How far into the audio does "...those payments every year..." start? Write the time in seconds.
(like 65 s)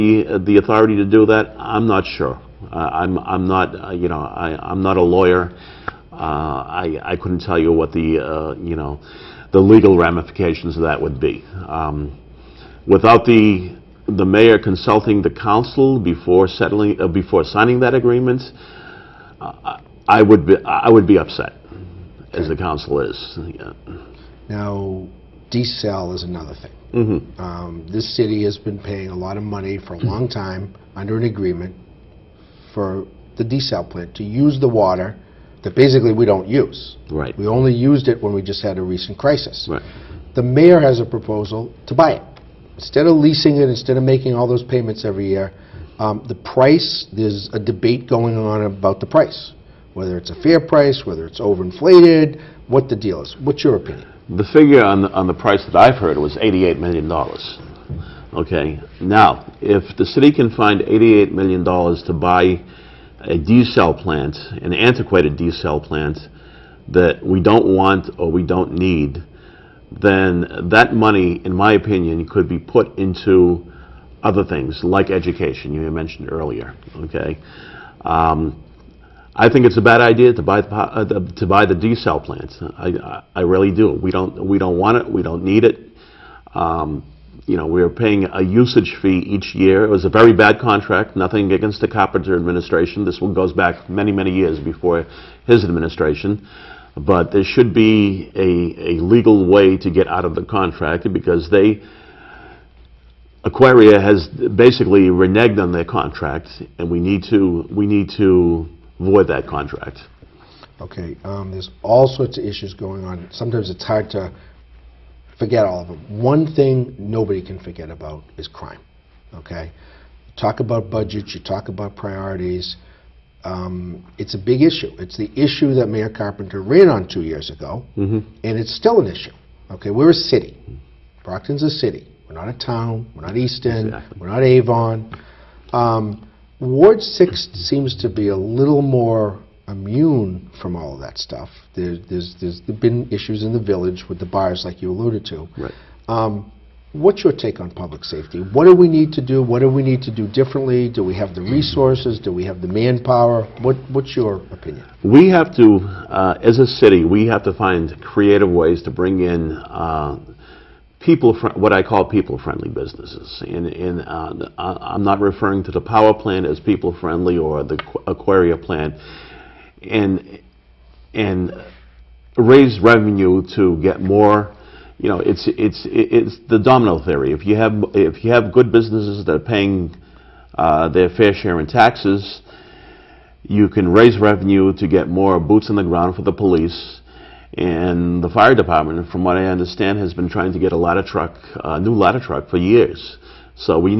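44 s.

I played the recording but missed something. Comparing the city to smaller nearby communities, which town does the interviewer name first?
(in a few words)
Easton.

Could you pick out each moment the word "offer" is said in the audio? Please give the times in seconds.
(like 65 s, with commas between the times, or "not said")
not said.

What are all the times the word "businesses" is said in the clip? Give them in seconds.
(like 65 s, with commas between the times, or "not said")
162 s, 178 s.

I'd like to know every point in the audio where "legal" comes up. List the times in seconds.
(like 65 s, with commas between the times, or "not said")
9 s, 99 s.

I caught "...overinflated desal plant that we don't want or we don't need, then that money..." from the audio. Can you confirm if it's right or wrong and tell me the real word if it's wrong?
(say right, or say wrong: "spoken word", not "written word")
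wrong: "antiquated", not "overinflated".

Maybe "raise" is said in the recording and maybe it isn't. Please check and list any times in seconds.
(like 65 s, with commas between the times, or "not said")
172 s, 183 s.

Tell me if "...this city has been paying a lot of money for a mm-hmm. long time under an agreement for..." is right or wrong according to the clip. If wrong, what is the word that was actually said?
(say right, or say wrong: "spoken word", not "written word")
right.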